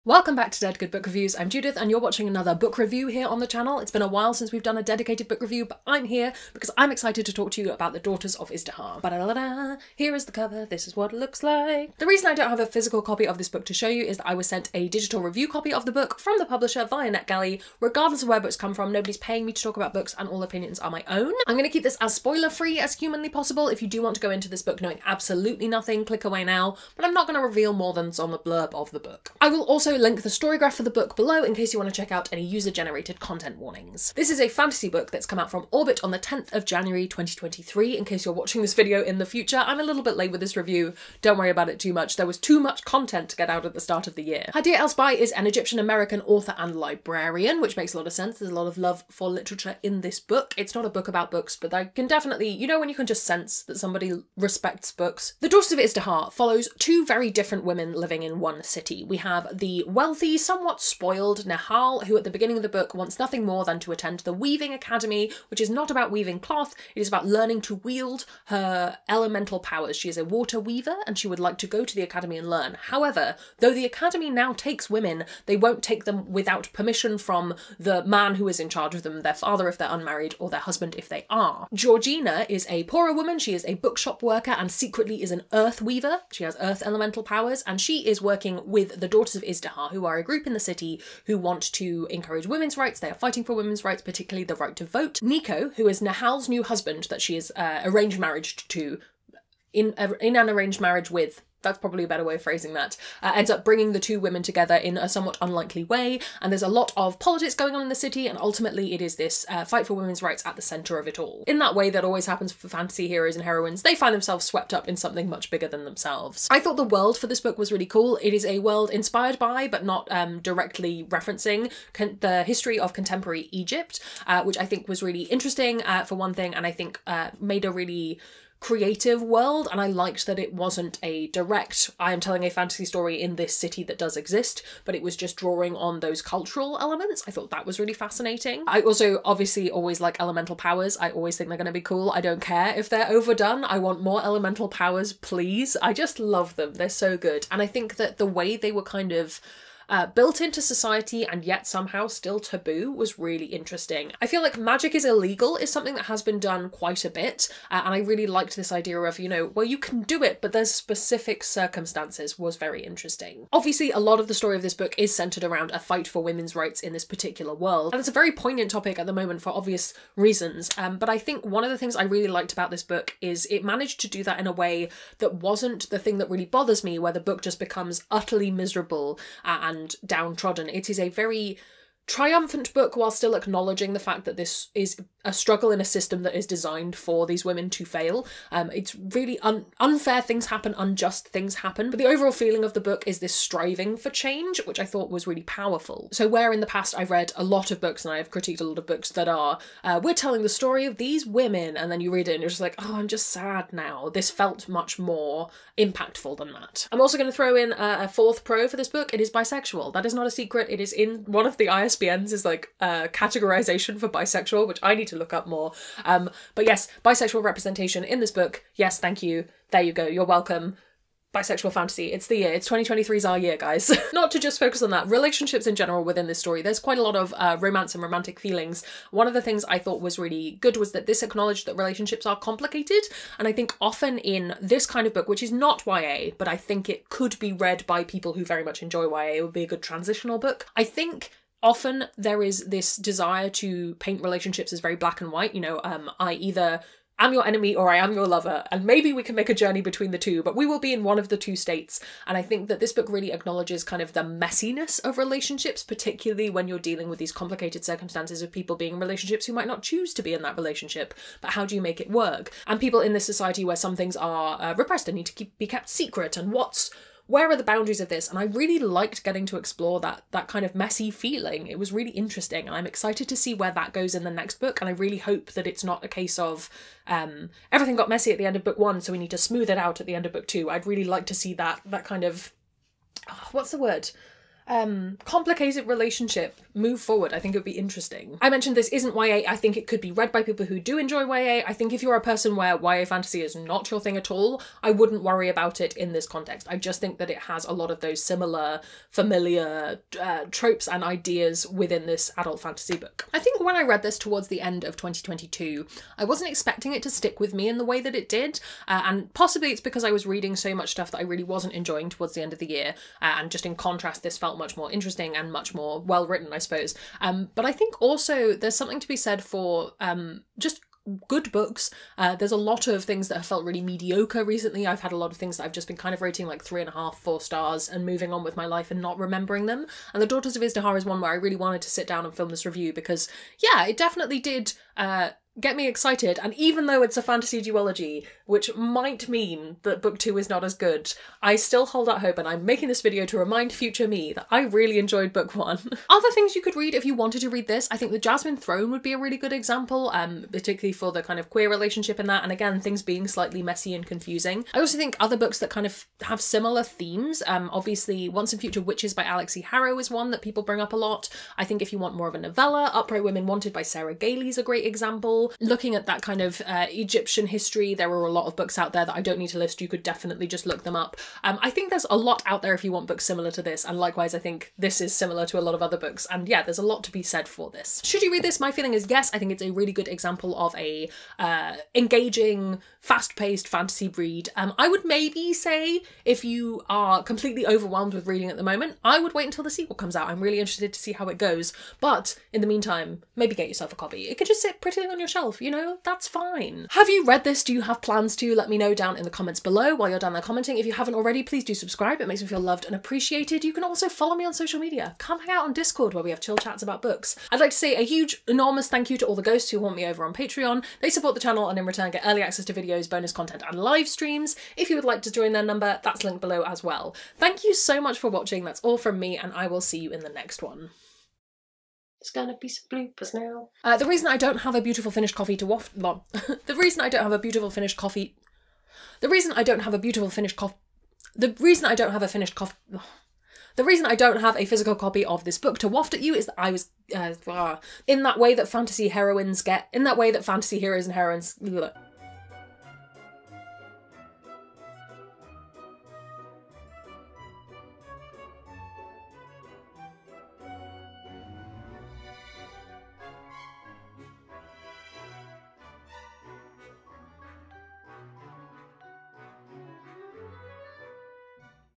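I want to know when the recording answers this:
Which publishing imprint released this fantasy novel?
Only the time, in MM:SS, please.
00:35.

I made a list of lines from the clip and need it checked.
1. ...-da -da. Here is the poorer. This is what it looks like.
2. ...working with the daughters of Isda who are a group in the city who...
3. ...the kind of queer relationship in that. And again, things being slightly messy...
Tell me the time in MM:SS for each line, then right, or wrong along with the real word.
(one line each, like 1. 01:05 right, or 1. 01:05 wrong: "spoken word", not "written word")
1. 00:09 wrong: "cover", not "poorer"
2. 01:28 right
3. 05:51 right.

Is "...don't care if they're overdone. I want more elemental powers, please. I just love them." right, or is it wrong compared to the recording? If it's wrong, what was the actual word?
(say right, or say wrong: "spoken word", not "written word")
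right.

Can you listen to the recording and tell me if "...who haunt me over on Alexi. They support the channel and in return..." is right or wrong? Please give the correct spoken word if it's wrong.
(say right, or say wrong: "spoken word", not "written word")
wrong: "Patreon", not "Alexi".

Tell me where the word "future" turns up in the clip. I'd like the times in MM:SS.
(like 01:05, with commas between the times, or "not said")
00:39, 05:43, 05:58.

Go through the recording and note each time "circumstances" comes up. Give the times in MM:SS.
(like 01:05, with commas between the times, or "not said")
02:41, 04:17.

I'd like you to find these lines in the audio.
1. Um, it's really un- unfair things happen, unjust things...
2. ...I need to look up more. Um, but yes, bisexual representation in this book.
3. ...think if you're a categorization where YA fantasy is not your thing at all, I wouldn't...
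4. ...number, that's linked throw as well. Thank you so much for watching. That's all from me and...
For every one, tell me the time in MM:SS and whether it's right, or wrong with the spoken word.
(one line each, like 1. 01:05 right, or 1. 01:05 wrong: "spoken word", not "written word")
1. 03:08 right
2. 03:34 right
3. 04:51 wrong: "person", not "categorization"
4. 06:55 wrong: "below", not "throw".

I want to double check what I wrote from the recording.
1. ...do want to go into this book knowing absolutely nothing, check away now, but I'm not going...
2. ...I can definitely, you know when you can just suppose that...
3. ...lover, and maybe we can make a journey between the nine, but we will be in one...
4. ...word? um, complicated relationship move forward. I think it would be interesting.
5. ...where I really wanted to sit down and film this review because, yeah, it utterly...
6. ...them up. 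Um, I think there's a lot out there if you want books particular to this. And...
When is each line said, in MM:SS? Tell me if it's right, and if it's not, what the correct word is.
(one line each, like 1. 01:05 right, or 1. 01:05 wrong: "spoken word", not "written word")
1. 00:23 wrong: "click", not "check"
2. 00:51 wrong: "sense", not "suppose"
3. 04:08 wrong: "two", not "nine"
4. 04:43 right
5. 05:31 wrong: "definitely", not "utterly"
6. 06:10 wrong: "similar", not "particular".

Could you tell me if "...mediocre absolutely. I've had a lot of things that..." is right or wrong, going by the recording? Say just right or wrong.
wrong.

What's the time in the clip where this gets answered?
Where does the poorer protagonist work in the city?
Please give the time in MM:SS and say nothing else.
01:23.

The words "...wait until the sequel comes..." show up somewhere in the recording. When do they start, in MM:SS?
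06:29.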